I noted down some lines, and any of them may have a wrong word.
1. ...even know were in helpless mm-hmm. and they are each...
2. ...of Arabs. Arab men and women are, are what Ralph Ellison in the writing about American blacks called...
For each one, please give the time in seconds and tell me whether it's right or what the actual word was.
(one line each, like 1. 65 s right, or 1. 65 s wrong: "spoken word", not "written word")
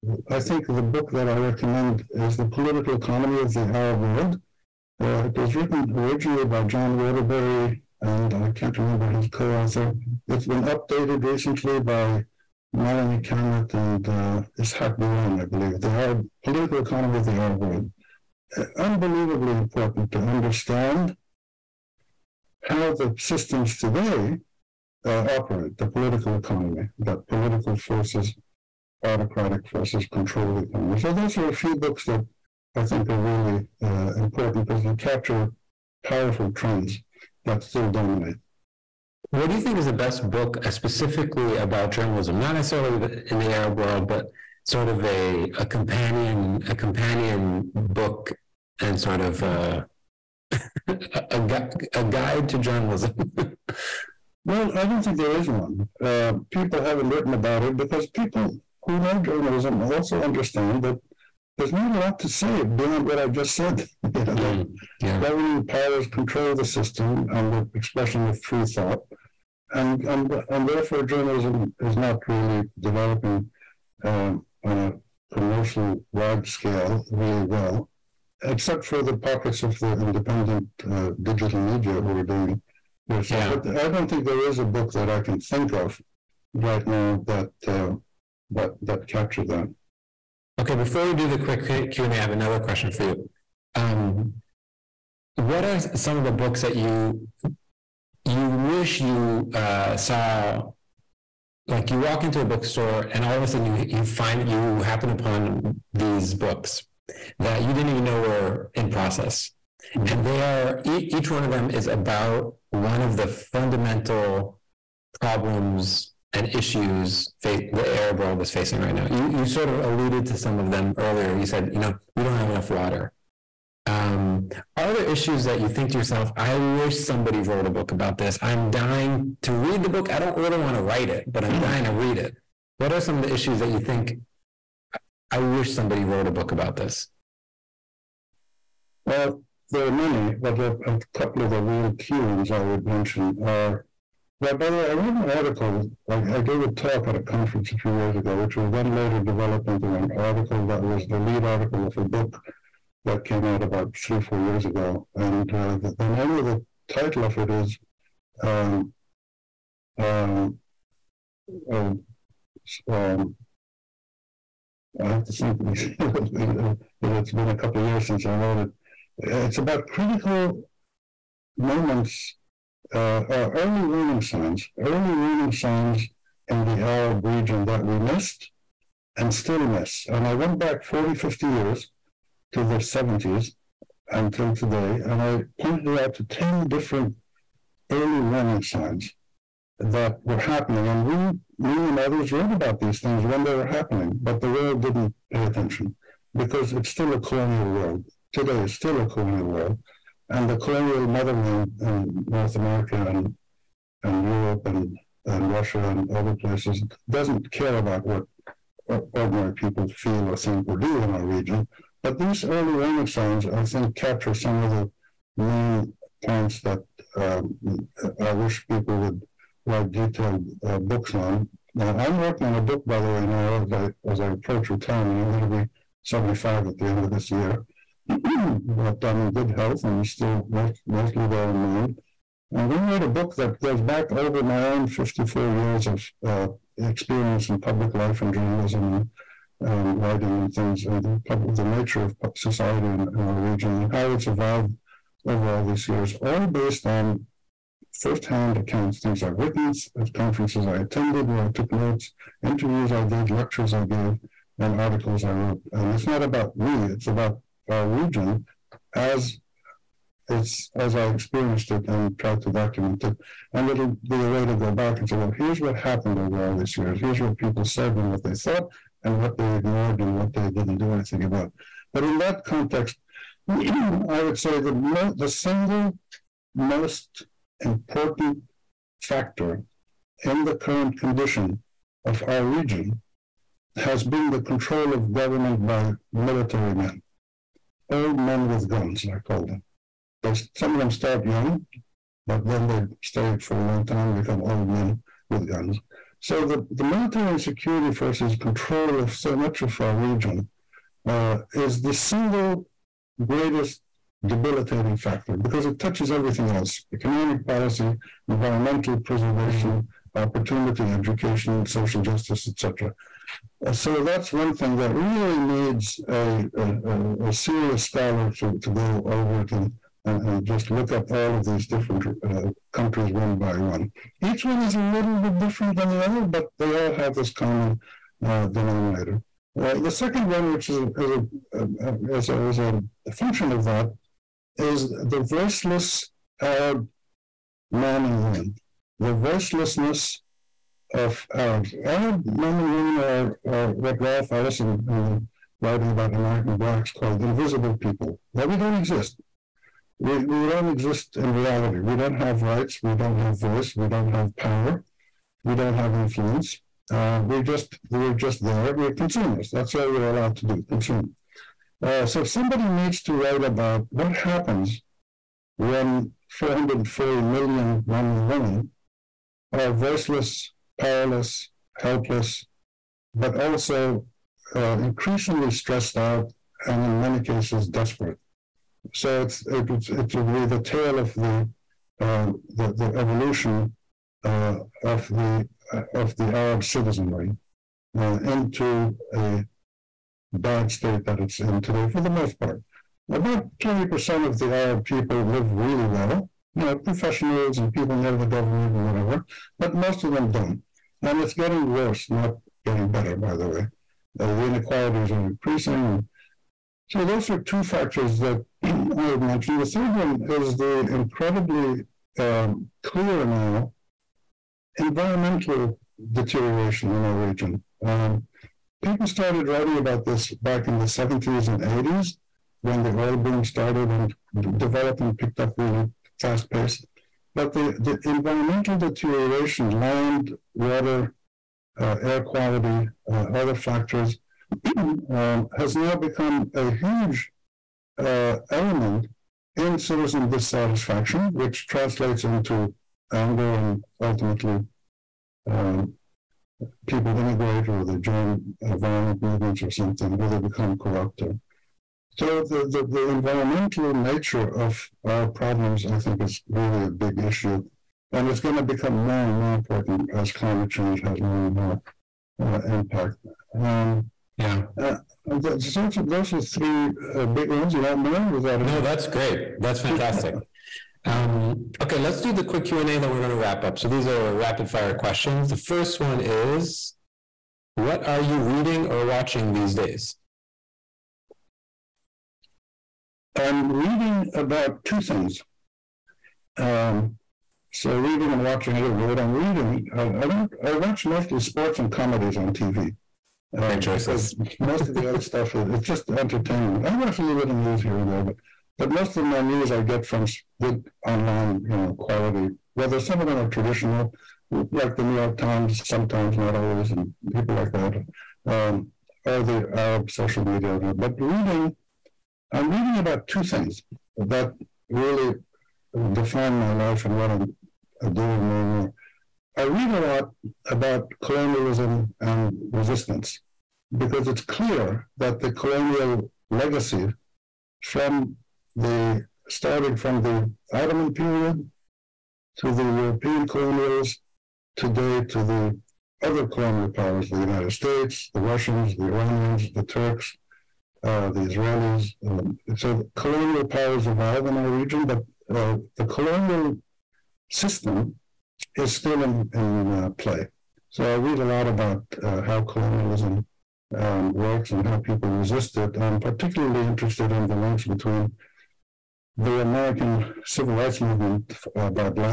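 1. 107 s wrong: "process", not "helpless"
2. 340 s right.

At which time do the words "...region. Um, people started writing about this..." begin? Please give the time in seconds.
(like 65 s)
417 s.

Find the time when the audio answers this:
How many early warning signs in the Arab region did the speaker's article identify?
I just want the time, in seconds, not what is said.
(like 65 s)
186 s.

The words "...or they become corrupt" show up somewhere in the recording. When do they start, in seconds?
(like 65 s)
450 s.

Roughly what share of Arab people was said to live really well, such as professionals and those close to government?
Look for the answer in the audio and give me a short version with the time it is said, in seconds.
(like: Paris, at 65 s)
20%, at 393 s.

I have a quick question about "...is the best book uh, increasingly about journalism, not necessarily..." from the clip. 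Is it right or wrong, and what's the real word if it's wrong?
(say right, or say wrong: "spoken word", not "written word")
wrong: "specifically", not "increasingly".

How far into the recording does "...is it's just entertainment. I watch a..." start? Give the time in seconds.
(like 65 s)
495 s.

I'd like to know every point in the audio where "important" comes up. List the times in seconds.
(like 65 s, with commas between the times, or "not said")
19 s, 34 s, 277 s, 459 s.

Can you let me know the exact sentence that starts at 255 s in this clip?
And it's not about me, it's about our region as it's as I experienced it and tried to document it.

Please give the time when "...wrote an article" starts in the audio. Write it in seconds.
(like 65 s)
144 s.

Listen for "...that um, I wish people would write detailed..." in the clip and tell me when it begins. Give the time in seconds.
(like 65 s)
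216 s.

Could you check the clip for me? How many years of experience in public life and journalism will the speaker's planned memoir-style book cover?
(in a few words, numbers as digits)
54.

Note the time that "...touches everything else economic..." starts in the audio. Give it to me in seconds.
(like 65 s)
305 s.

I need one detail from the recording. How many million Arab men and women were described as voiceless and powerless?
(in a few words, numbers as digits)
440.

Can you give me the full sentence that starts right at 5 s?
Uh, it was written originally by John Waterbury, and I can't remember his co author.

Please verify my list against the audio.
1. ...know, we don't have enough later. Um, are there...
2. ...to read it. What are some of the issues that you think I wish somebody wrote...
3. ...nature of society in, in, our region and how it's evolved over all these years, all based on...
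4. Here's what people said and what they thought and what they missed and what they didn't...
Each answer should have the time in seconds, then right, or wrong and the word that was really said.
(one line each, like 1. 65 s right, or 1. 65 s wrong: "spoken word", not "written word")
1. 121 s wrong: "water", not "later"
2. 131 s right
3. 241 s right
4. 266 s wrong: "ignored", not "missed".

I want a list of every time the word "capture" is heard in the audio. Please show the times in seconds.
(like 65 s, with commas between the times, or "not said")
34 s, 89 s, 213 s.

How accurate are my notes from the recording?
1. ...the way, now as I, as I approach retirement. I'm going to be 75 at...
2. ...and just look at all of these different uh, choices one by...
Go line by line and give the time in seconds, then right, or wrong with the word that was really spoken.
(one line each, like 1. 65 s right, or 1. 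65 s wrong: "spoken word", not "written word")
1. 222 s right
2. 320 s wrong: "countries", not "choices".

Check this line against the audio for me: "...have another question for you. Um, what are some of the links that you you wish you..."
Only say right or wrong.
wrong.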